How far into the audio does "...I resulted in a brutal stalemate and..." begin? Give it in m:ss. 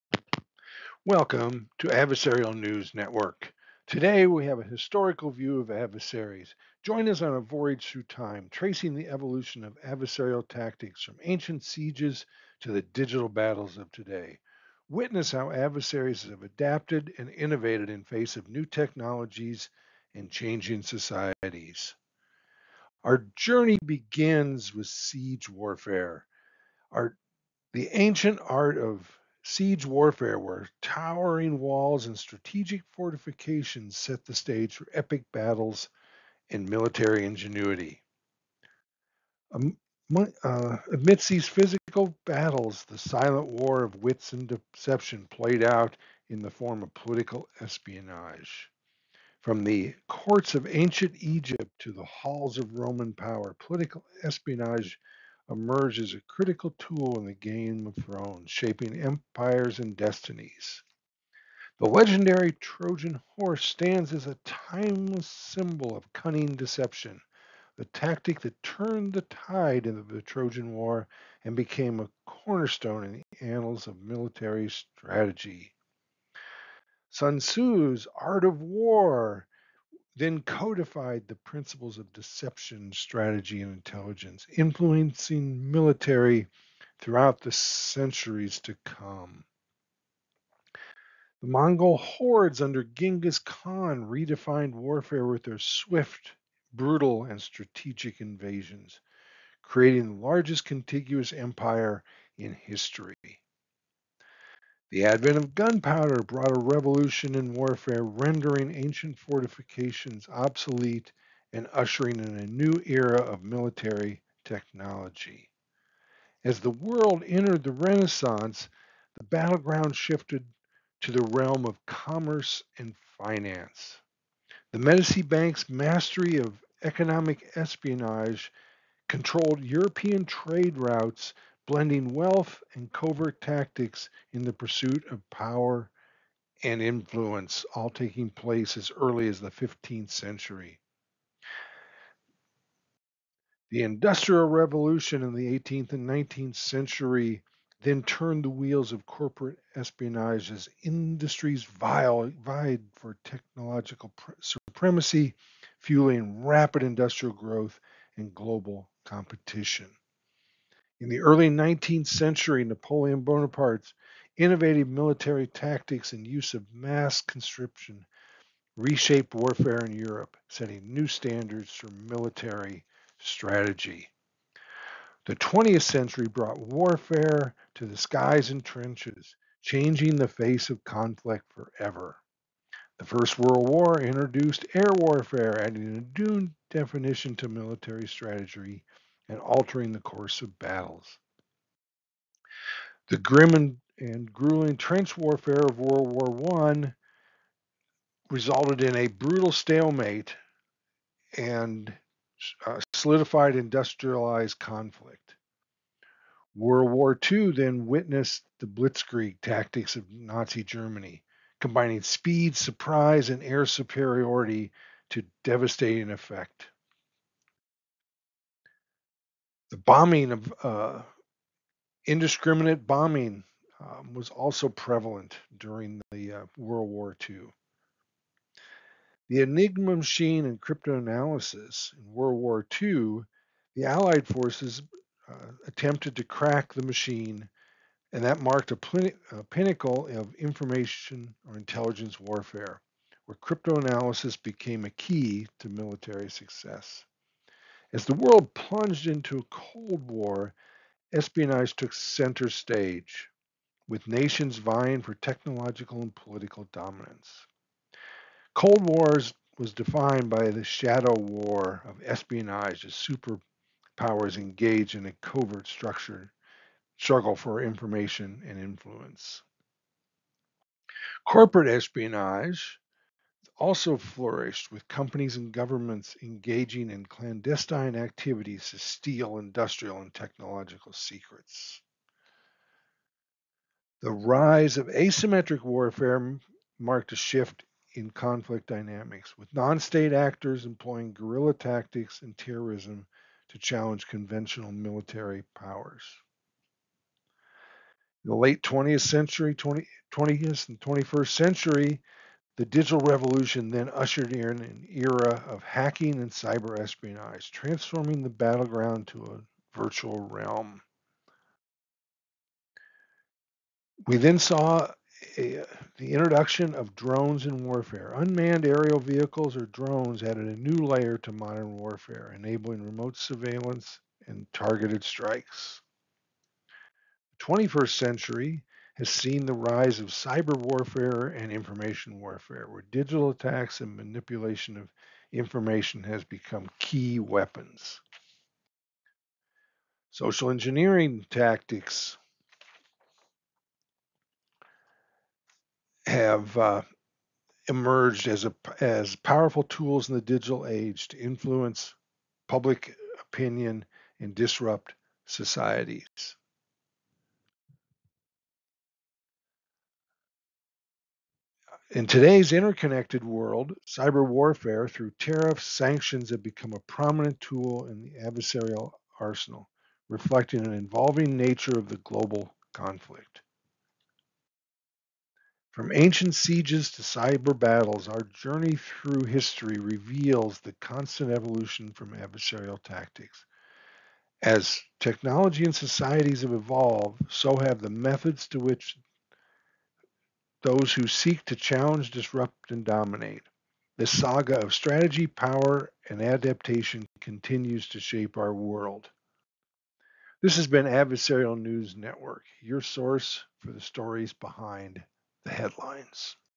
3:16.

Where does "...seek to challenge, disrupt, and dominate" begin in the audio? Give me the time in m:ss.
6:31.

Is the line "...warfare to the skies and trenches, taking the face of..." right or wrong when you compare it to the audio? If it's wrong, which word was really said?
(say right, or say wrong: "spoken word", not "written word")
wrong: "changing", not "taking".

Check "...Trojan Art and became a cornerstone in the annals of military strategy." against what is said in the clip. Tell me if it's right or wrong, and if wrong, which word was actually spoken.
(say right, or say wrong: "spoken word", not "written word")
wrong: "War", not "Art".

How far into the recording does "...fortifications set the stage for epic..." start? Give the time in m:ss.
0:32.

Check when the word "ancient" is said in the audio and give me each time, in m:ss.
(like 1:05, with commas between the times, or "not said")
0:11, 0:27, 0:50, 1:48, 6:15.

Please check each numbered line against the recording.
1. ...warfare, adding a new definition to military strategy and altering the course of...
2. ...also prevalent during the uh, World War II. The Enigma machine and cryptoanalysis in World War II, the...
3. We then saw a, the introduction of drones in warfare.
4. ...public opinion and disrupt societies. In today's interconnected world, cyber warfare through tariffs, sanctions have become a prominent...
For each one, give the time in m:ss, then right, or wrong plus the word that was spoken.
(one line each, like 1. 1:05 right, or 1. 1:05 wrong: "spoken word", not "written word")
1. 3:04 right
2. 3:44 right
3. 5:14 right
4. 5:52 right.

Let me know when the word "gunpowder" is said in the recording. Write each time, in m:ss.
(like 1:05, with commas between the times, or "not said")
1:45.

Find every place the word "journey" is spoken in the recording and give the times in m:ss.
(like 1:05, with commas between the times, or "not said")
0:23, 6:18.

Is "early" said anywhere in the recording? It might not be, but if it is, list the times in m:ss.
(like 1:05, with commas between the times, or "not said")
2:18, 2:41.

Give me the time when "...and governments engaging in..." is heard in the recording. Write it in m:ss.
4:35.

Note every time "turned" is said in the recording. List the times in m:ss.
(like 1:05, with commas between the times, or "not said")
1:08, 2:28.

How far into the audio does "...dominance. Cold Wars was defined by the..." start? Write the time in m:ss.
4:16.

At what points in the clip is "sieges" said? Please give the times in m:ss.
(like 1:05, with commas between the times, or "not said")
0:11, 0:24, 0:29, 6:16.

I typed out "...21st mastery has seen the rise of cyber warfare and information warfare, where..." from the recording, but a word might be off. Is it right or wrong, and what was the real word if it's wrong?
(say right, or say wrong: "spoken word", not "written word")
wrong: "century", not "mastery".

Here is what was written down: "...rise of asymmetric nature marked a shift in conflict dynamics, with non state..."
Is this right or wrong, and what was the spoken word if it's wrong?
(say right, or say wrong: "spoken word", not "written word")
wrong: "warfare", not "nature".